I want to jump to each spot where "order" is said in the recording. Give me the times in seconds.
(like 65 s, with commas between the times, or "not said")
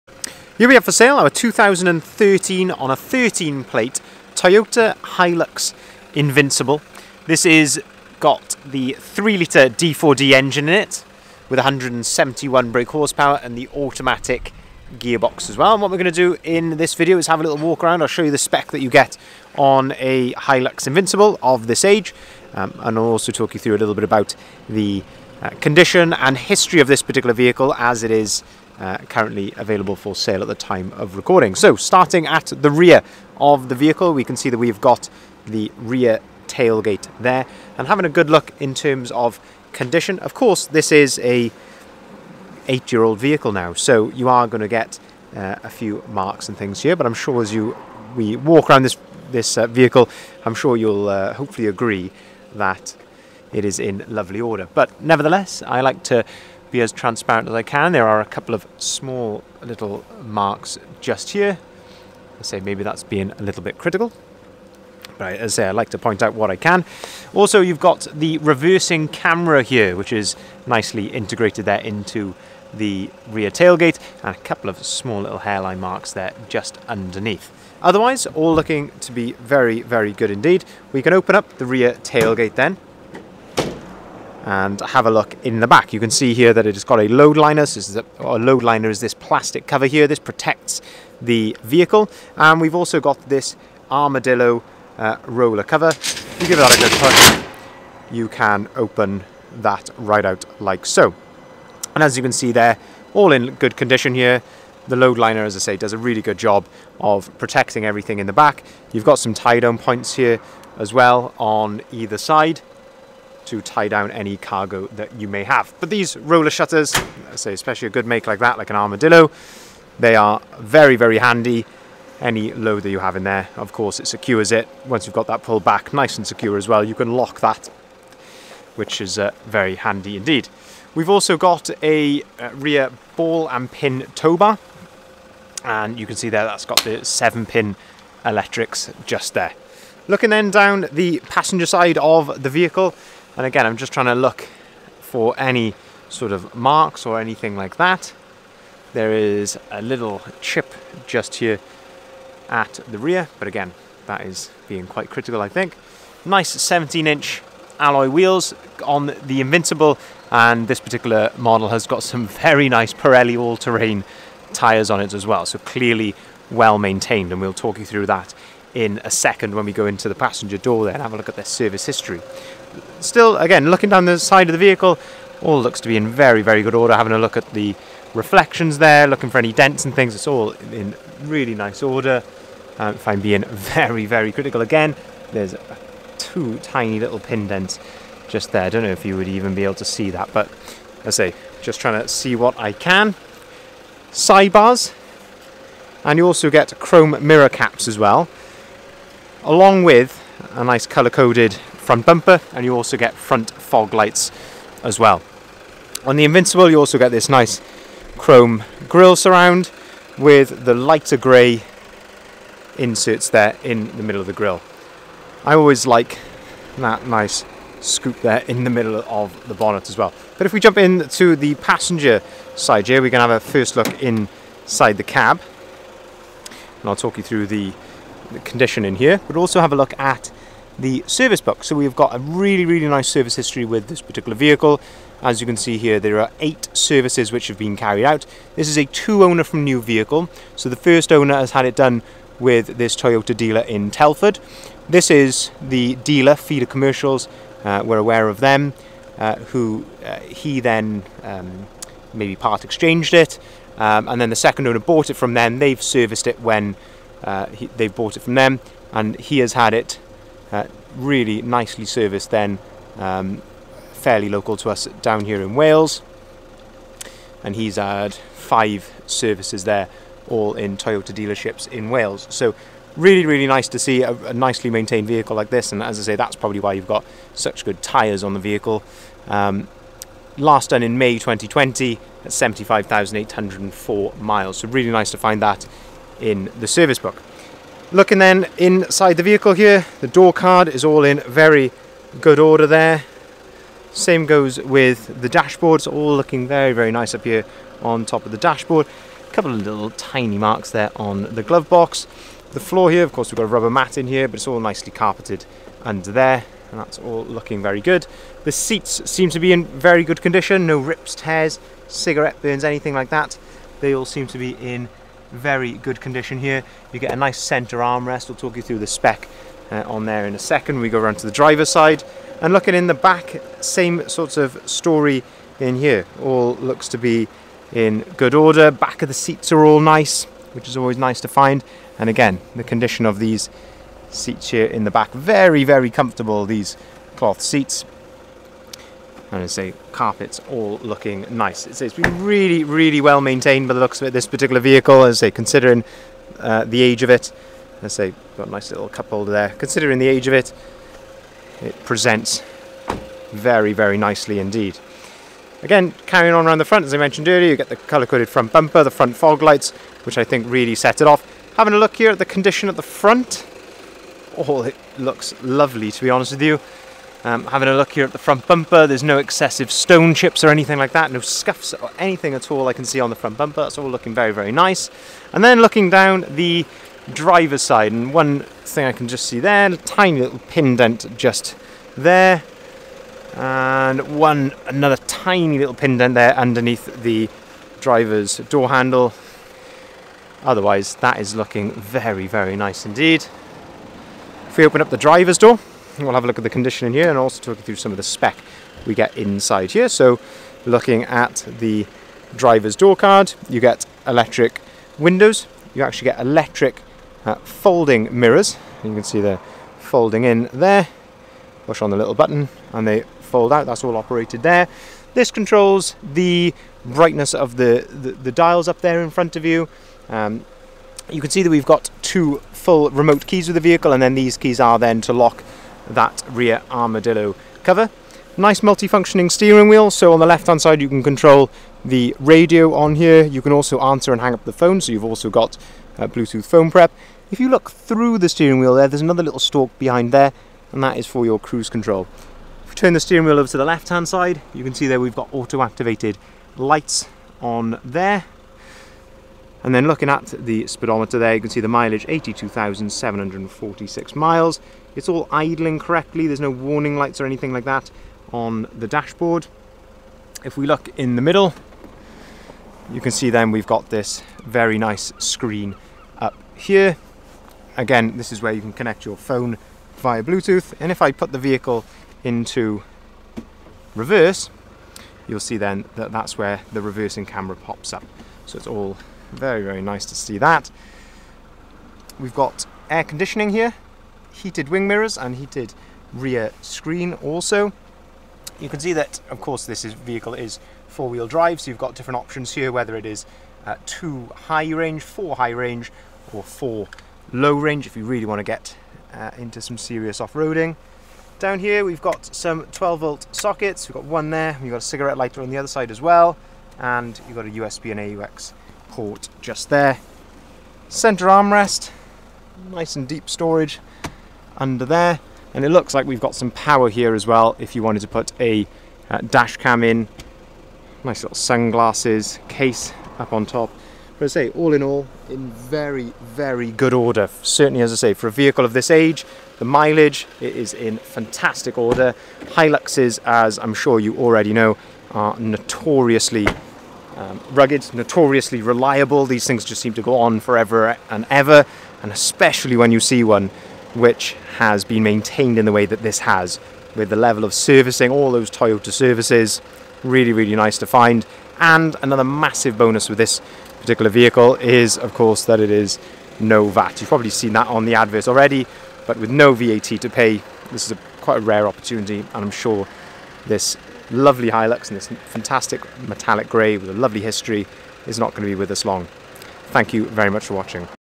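54 s, 176 s, 181 s, 292 s, 328 s, 526 s, 531 s.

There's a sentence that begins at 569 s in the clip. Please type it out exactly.
Thank you very much for watching.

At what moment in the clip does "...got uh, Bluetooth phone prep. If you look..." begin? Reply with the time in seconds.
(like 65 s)
435 s.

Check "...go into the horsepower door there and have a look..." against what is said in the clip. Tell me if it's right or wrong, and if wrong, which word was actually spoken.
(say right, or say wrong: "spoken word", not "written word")
wrong: "passenger", not "horsepower".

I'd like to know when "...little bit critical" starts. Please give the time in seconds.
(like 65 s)
63 s.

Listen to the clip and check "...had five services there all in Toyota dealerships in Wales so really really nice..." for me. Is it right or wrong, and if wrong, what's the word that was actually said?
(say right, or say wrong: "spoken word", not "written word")
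right.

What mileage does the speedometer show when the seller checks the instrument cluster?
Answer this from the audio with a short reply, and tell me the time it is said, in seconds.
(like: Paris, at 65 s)
82,746 miles, at 452 s.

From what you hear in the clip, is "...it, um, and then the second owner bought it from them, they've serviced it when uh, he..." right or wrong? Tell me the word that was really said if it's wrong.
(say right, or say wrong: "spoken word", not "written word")
right.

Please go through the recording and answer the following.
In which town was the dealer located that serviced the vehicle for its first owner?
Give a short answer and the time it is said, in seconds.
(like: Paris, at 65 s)
Telford, at 243 s.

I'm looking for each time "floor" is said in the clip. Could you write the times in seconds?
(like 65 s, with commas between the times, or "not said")
302 s.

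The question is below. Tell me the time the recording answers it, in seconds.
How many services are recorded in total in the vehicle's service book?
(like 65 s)
236 s.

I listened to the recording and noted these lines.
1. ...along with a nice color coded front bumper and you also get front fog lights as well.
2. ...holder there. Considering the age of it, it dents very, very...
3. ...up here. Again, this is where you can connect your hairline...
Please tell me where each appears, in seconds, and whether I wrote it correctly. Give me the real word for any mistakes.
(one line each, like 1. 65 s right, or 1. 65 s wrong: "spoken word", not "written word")
1. 199 s right
2. 349 s wrong: "presents", not "dents"
3. 466 s wrong: "phone", not "hairline".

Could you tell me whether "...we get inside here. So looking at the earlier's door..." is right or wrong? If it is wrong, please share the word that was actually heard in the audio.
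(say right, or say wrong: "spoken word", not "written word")
wrong: "driver", not "earlier".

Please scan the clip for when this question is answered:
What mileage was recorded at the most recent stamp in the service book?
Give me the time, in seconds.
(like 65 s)
282 s.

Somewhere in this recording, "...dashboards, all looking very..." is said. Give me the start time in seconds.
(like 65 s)
295 s.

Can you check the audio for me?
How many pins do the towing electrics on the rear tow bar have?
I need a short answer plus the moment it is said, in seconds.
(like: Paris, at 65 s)
7, at 137 s.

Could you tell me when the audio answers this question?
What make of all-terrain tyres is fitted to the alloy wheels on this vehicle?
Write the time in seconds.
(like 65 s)
162 s.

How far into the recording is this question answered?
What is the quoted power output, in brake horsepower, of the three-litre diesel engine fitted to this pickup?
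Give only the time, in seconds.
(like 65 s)
11 s.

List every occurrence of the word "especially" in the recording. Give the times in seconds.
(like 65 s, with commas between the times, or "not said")
117 s, 542 s.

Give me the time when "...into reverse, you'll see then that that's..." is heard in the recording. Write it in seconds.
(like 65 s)
472 s.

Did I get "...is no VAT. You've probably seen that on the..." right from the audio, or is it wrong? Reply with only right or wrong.
right.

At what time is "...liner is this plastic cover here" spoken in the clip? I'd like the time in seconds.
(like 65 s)
88 s.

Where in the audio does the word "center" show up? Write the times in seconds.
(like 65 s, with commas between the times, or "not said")
317 s, 510 s.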